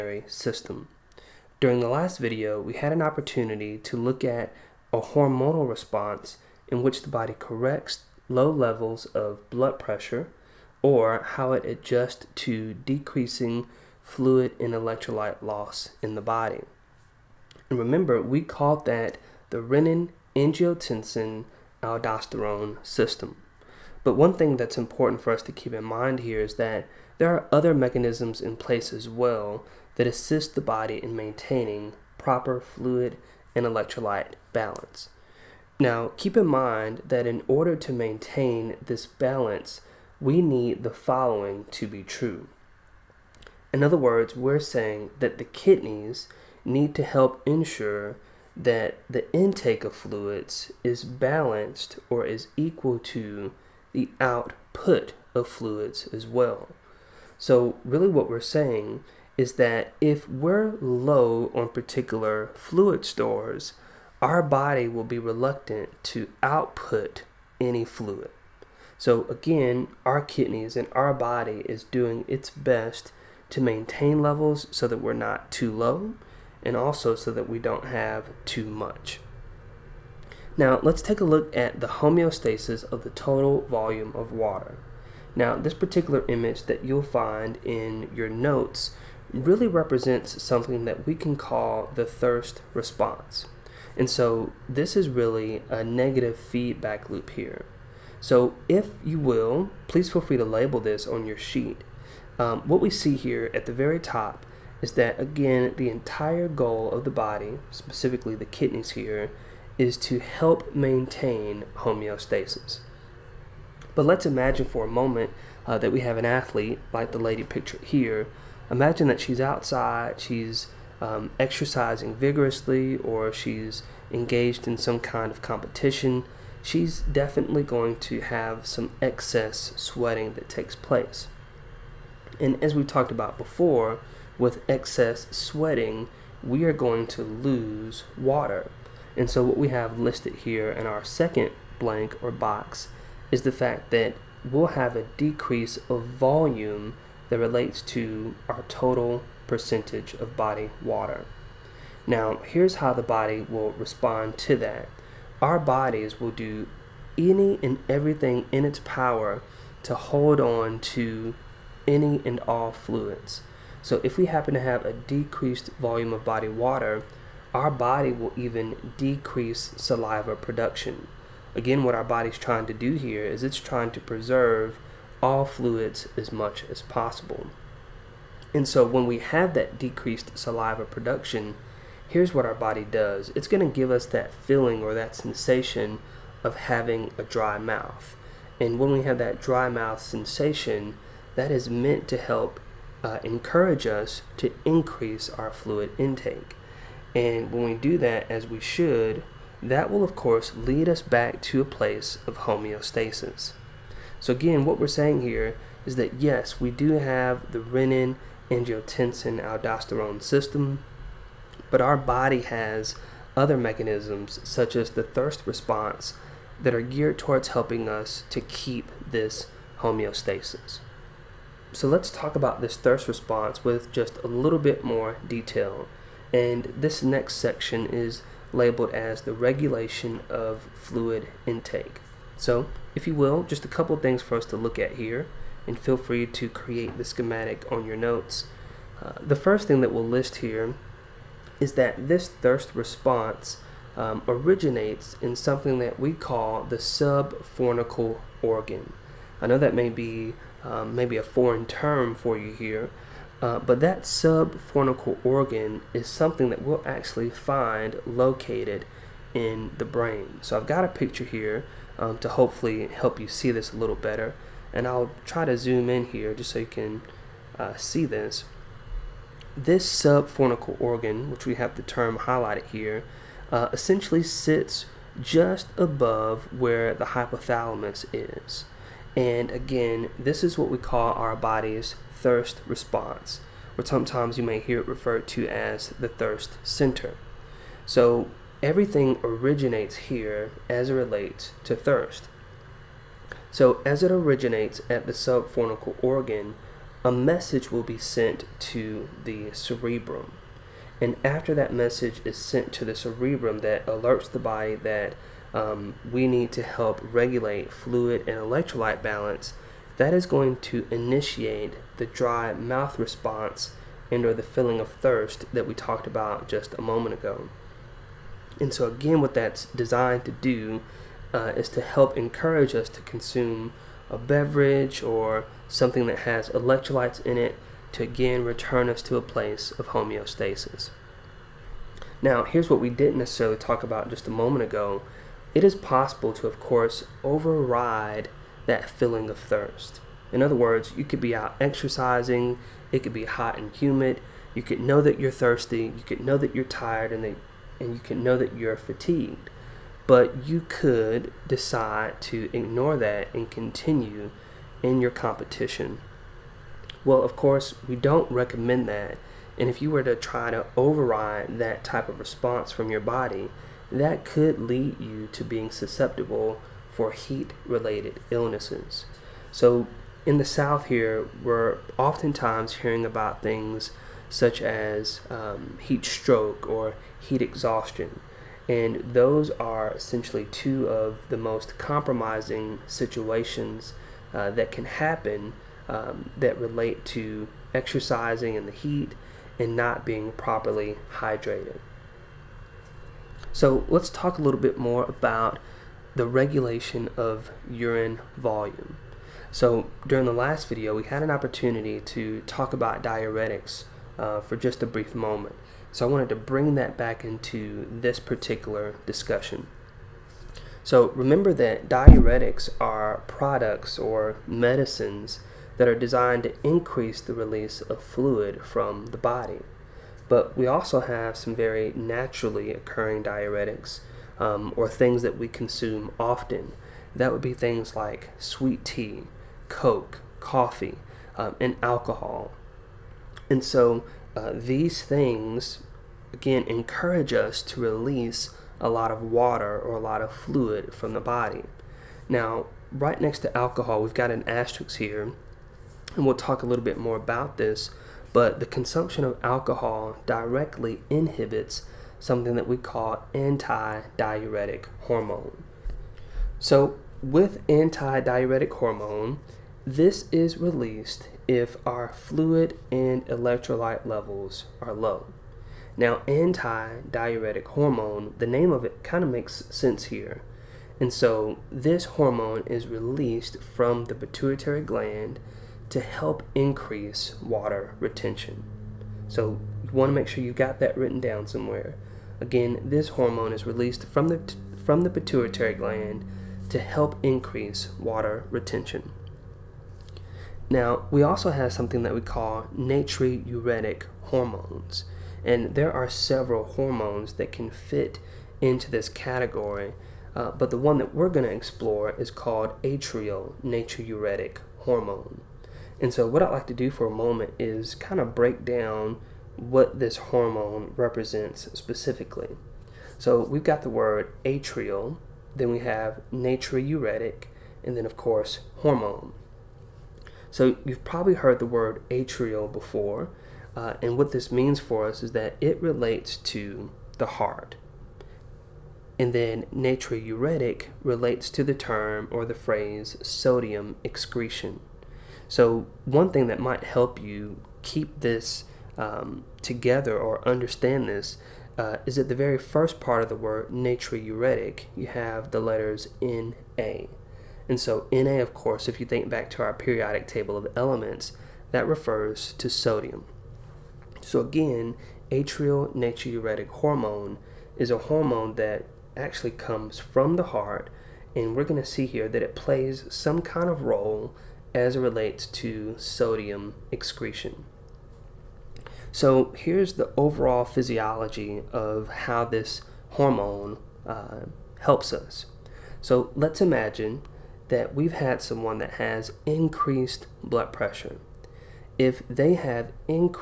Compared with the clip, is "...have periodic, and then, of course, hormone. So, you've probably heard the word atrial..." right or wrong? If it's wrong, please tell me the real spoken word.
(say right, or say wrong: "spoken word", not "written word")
wrong: "natriuretic", not "periodic".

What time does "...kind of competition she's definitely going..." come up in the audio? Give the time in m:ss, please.
2:04.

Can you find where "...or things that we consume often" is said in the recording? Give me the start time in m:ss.
7:04.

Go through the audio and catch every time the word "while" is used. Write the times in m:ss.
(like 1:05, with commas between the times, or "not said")
not said.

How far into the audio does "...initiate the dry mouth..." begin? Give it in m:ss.
5:10.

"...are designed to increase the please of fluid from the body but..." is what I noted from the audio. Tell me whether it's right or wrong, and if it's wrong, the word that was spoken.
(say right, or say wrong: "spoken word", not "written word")
wrong: "release", not "please".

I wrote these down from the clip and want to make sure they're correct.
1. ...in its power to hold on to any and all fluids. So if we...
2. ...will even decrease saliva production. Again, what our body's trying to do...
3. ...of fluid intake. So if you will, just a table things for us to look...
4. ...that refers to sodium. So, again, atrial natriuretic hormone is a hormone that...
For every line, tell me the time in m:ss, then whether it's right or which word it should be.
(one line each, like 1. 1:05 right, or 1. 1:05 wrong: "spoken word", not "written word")
1. 2:38 right
2. 2:48 right
3. 3:50 wrong: "couple", not "table"
4. 9:11 right.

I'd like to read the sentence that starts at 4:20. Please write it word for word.
So I've got a picture here um, to hopefully help you see this a little better.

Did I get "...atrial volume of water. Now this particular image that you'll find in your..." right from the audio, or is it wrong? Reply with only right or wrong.
wrong.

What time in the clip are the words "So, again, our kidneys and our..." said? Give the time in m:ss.
1:08.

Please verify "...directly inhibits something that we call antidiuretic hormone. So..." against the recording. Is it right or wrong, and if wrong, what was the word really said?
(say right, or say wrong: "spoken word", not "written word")
right.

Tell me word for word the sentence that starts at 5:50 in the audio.
But you could decide to ignore that and continue in your competition.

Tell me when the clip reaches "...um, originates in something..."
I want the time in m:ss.
4:03.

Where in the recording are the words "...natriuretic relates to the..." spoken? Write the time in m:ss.
8:49.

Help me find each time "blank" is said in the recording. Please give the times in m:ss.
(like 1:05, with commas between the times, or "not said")
2:21.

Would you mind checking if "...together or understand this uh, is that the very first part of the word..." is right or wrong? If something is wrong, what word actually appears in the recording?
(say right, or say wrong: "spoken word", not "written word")
right.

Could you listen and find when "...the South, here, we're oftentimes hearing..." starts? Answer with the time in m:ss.
6:10.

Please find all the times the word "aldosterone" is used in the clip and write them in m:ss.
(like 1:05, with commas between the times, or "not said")
0:21, 3:29.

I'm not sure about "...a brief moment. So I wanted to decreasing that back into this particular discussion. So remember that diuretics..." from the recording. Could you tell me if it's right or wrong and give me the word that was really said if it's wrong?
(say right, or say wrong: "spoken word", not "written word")
wrong: "bring", not "decreasing".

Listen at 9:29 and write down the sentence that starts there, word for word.
So here's the overall physiology of how this hormone uh, helps us.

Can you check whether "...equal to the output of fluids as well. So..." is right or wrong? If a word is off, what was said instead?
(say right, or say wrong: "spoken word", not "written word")
right.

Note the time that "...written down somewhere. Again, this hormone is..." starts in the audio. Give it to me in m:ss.
8:00.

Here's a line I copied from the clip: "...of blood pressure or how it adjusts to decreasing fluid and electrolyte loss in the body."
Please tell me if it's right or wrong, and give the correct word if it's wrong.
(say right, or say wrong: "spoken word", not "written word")
right.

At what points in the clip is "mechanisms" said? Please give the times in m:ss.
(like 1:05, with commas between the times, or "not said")
0:27, 3:33.